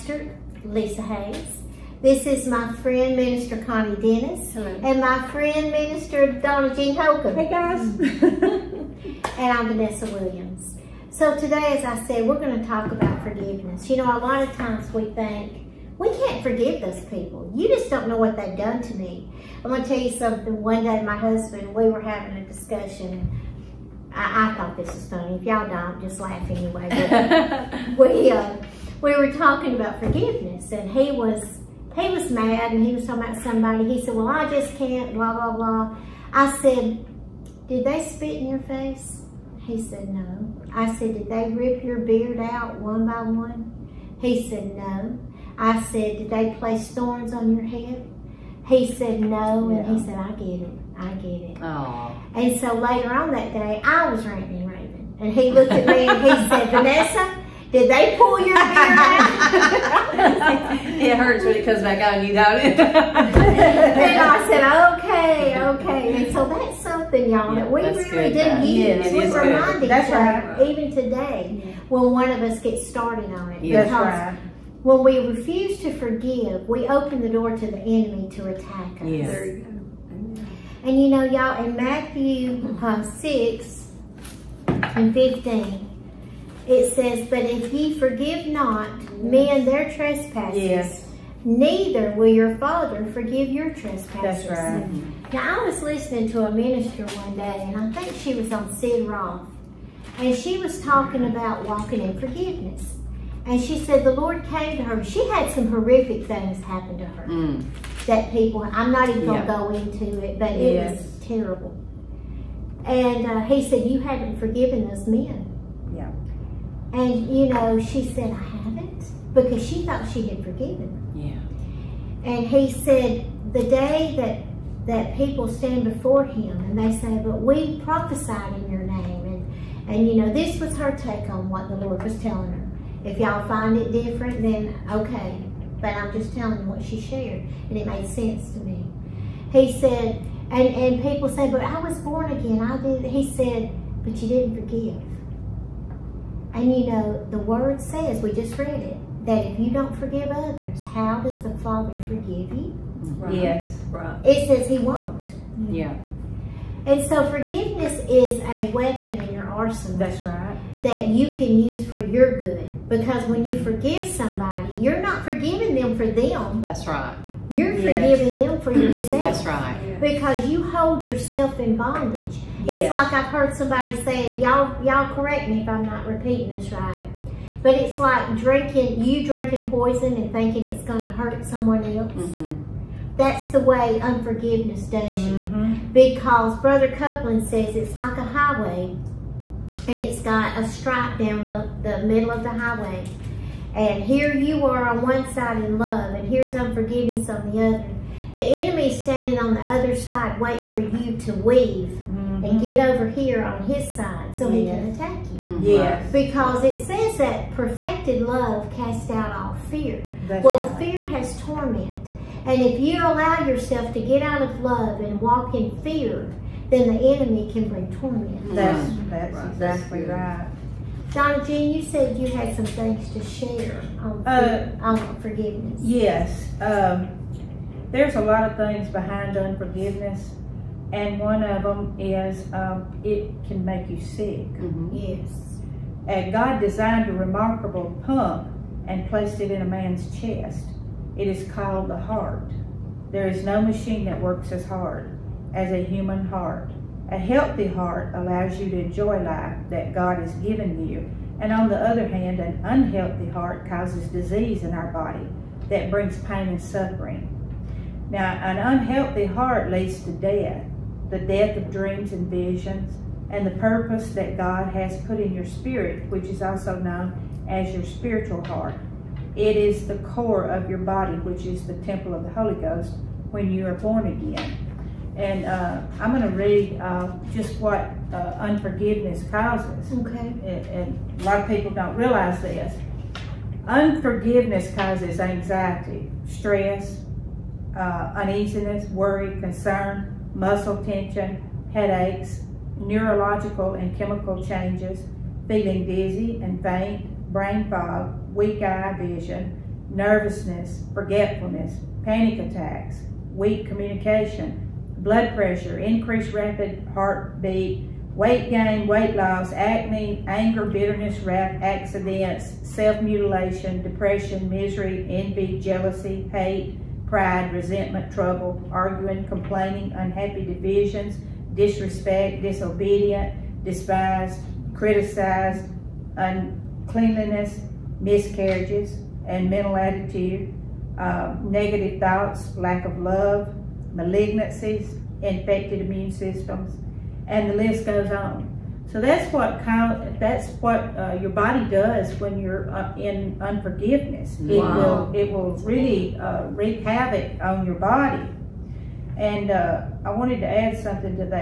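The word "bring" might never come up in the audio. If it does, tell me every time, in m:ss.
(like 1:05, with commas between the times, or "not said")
3:37, 4:15.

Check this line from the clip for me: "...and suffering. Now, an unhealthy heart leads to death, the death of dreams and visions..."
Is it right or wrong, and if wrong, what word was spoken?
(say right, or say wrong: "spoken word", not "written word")
right.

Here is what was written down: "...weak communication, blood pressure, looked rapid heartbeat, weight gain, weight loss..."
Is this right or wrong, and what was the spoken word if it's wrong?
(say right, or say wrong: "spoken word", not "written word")
wrong: "increased", not "looked".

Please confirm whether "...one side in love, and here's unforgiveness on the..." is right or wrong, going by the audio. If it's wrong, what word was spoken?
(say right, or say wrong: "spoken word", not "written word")
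right.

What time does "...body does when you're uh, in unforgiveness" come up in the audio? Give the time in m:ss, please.
5:41.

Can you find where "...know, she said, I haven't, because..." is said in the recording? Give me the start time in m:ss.
1:57.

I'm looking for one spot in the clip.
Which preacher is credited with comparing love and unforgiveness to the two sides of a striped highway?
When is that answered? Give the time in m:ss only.
3:06.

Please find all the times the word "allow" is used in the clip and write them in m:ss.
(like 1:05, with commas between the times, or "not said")
3:33, 4:08.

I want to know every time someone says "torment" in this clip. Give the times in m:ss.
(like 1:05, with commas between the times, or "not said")
3:31, 3:37.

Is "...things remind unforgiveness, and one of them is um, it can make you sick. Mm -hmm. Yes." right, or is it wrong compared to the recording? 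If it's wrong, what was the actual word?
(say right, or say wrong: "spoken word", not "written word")
wrong: "behind", not "remind".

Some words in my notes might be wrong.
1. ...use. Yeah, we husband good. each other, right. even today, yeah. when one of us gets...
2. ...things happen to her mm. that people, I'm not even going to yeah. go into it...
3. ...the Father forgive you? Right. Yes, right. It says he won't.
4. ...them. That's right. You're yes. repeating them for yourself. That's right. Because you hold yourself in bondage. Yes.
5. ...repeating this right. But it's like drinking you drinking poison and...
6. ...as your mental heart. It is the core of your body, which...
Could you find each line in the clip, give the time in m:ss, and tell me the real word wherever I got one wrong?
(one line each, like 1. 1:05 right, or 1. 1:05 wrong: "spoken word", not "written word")
1. 1:08 wrong: "remind", not "husband"
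2. 1:46 right
3. 2:31 right
4. 2:46 wrong: "forgiving", not "repeating"
5. 2:56 right
6. 4:27 wrong: "spiritual", not "mental".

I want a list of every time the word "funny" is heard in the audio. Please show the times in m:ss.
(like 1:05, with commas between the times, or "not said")
0:25.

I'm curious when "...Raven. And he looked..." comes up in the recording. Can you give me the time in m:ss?
0:54.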